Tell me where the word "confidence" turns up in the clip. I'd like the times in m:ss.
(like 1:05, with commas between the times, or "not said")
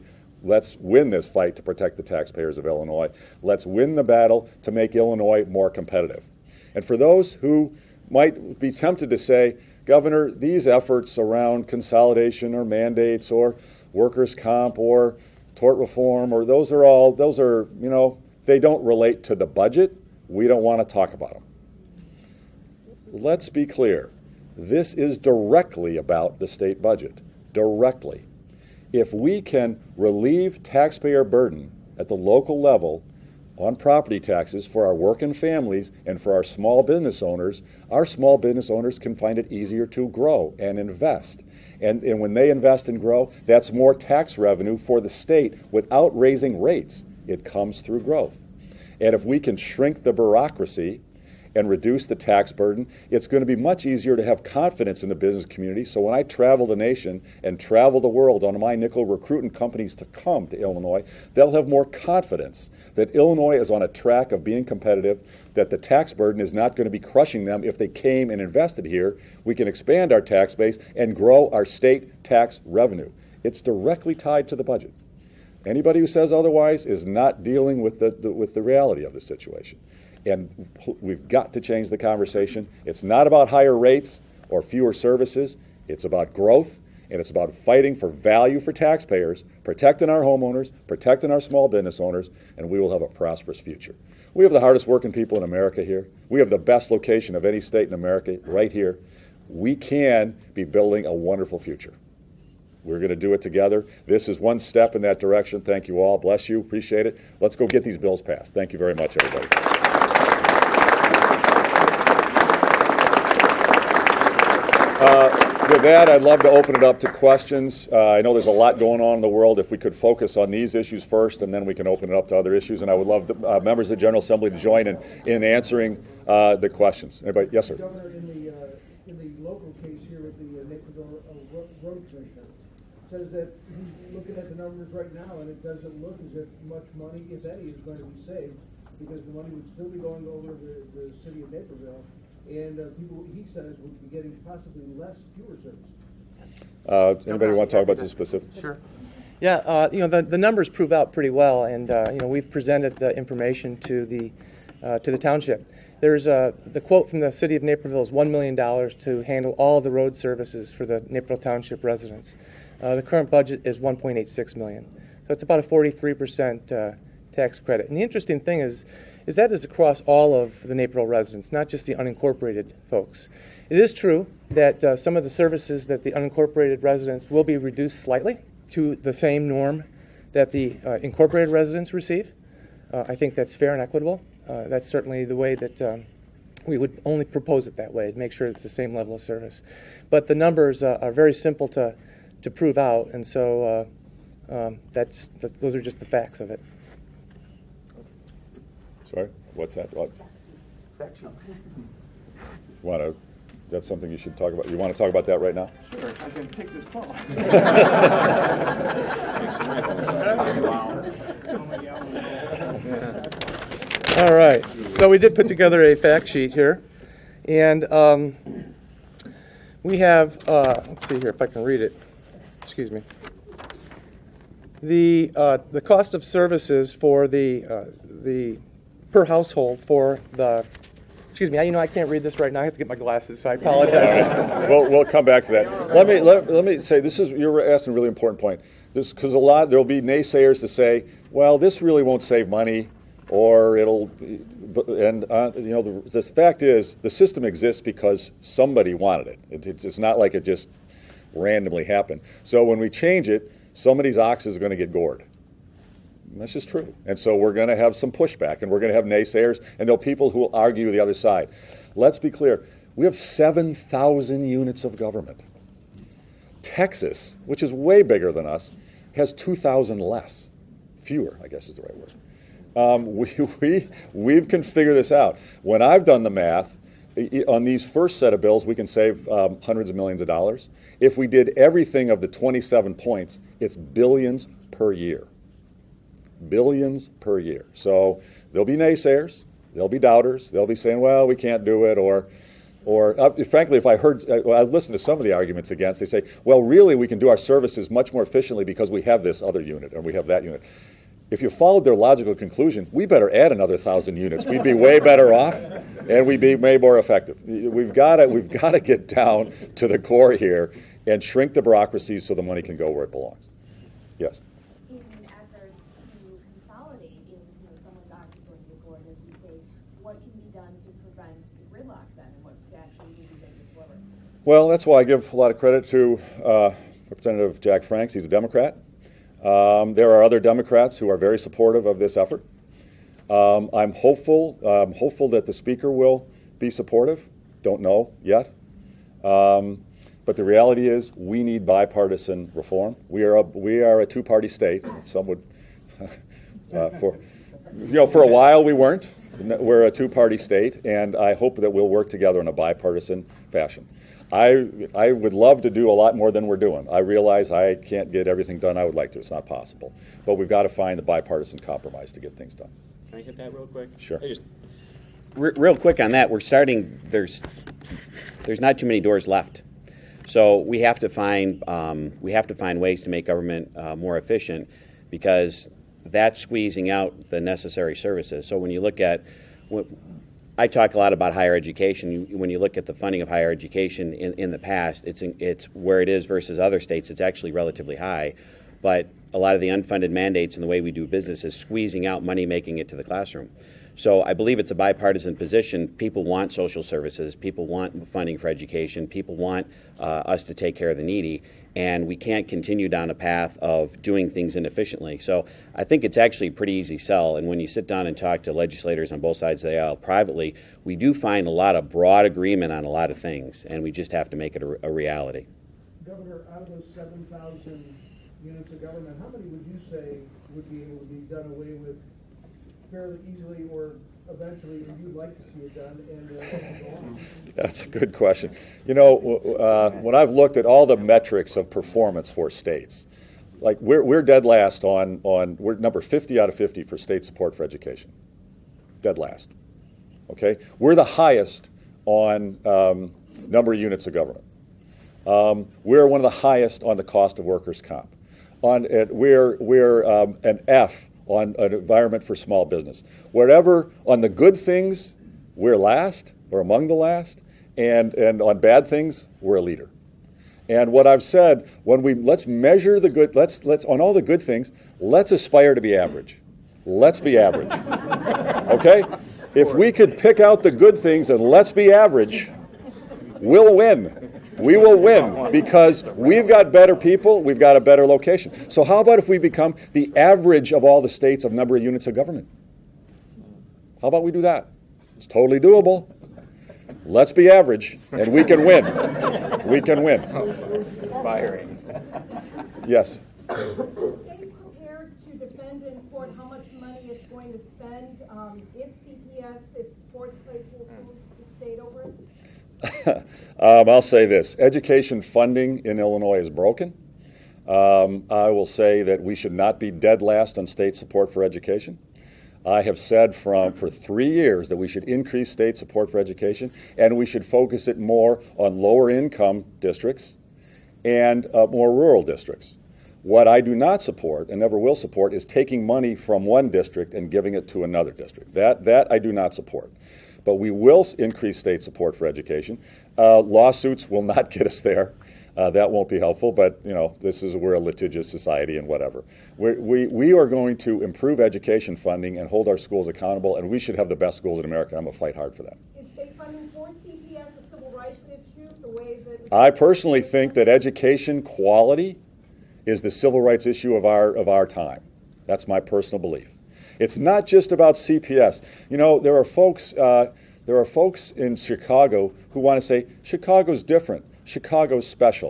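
0:54, 1:01.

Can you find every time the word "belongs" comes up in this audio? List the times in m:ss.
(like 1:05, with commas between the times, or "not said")
5:13.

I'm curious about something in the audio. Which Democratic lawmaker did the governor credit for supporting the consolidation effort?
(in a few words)
Jack Franks.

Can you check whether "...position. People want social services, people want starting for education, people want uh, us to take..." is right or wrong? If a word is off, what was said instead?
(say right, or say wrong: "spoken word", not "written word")
wrong: "funding", not "starting".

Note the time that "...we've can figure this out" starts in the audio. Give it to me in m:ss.
4:34.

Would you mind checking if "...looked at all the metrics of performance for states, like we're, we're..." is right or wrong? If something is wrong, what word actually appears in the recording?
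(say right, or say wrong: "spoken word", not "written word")
right.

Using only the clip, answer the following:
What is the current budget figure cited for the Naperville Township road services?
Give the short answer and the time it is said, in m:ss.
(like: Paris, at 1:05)
1.86 million, at 2:43.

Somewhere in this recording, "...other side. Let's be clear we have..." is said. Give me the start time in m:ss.
4:20.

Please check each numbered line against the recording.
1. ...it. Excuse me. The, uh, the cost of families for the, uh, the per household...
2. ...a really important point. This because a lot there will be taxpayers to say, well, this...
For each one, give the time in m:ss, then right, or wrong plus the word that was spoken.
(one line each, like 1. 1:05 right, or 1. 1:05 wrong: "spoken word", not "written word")
1. 3:41 wrong: "services", not "families"
2. 3:57 wrong: "naysayers", not "taxpayers".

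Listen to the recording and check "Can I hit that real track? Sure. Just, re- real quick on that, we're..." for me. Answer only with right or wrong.
wrong.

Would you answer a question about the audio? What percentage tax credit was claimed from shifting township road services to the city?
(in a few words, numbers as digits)
43 percent.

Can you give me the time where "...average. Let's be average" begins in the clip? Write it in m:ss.
7:45.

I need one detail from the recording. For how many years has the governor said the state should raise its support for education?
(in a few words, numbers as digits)
3.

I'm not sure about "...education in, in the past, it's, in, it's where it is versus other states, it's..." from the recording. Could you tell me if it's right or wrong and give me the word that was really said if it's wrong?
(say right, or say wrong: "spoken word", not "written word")
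right.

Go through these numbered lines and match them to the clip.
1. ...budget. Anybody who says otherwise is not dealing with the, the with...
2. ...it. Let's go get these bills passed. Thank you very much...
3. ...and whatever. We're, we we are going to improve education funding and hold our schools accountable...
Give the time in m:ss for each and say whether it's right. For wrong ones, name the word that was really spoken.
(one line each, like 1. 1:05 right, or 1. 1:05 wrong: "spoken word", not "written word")
1. 1:14 right
2. 1:47 right
3. 8:58 right.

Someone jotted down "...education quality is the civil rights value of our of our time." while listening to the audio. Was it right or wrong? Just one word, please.
wrong.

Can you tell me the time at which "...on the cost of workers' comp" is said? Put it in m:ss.
7:26.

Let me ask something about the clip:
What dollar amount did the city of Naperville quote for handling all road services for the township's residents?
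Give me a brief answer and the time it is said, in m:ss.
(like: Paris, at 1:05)
$1 million, at 2:38.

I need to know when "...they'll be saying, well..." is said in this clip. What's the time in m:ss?
4:50.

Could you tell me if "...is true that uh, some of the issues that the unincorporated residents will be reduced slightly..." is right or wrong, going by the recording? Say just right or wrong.
wrong.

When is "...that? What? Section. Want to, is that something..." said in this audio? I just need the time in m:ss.
3:19.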